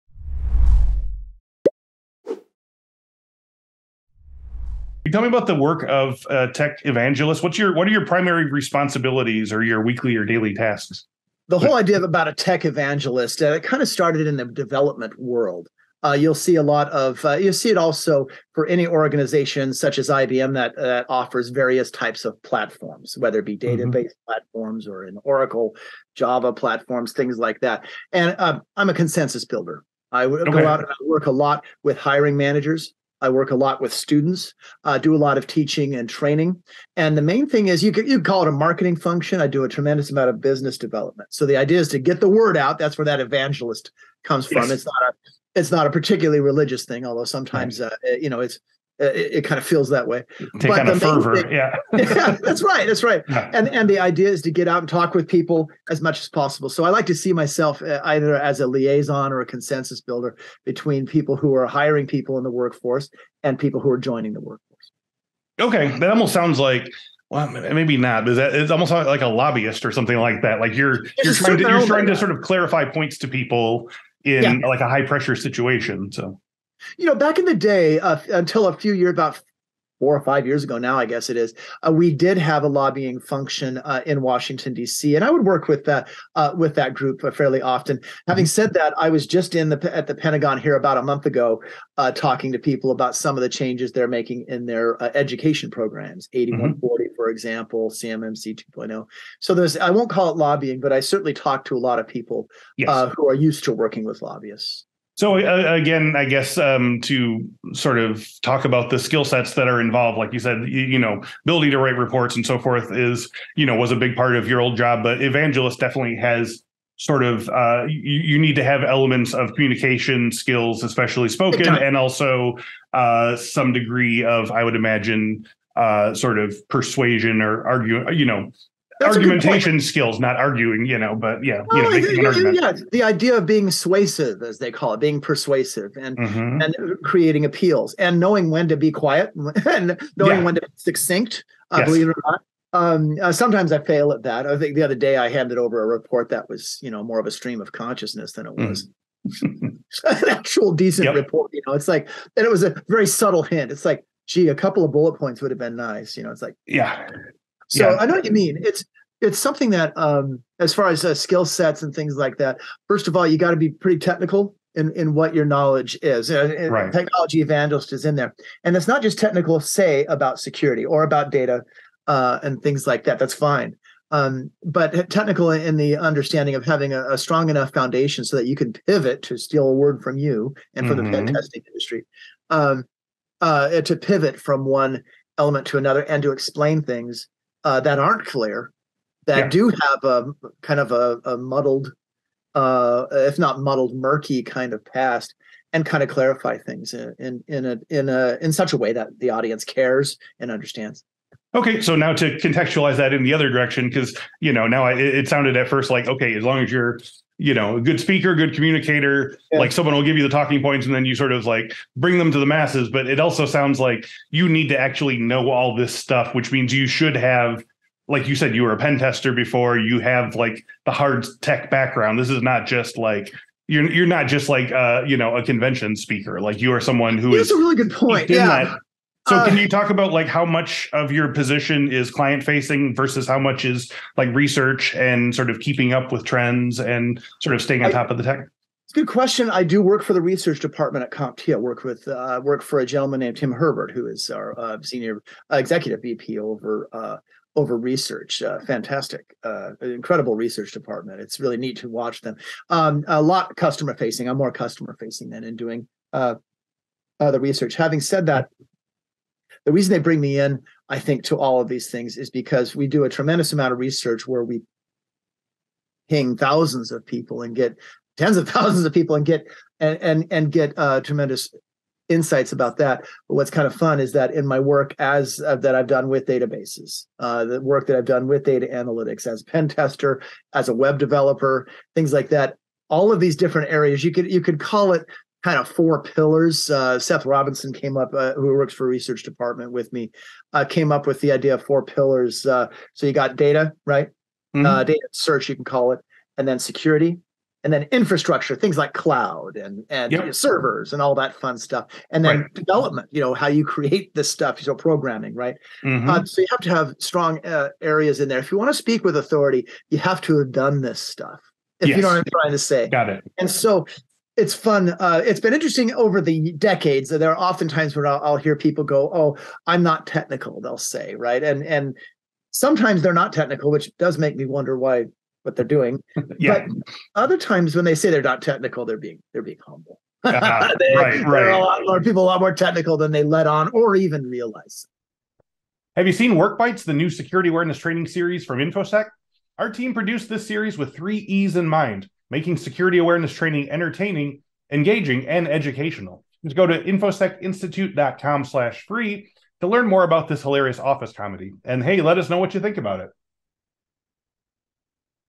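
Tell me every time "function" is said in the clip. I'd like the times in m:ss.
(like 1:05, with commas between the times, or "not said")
0:38, 1:23.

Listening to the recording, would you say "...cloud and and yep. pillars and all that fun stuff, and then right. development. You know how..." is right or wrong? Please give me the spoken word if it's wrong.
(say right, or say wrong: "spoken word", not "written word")
wrong: "servers", not "pillars".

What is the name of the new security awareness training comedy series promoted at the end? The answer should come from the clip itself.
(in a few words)
WorkBytes.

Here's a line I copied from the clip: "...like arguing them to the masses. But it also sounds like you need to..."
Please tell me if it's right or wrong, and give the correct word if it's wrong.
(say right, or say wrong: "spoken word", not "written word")
wrong: "bring", not "arguing".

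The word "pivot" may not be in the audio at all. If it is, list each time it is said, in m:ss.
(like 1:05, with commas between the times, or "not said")
2:58, 3:03.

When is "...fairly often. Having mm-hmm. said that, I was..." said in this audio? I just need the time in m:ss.
1:27.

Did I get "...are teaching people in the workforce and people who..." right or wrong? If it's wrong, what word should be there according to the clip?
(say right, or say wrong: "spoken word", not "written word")
wrong: "hiring", not "teaching".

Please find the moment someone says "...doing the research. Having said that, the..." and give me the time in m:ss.
4:15.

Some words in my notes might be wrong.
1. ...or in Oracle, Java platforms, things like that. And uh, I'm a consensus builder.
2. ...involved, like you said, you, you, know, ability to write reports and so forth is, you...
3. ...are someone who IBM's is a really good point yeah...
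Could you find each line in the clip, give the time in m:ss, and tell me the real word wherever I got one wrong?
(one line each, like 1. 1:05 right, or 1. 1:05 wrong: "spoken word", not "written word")
1. 0:24 right
2. 1:49 right
3. 3:46 wrong: "That", not "IBM".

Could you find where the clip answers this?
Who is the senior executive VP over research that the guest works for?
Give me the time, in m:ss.
4:03.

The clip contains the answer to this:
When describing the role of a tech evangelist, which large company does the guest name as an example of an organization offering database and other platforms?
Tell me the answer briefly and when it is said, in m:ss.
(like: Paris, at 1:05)
IBM, at 0:20.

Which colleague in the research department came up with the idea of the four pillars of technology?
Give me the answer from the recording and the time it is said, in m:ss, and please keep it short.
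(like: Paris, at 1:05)
Seth Robinson, at 4:46.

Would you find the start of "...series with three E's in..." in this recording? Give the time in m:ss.
5:40.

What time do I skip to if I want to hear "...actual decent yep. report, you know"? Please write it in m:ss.
2:30.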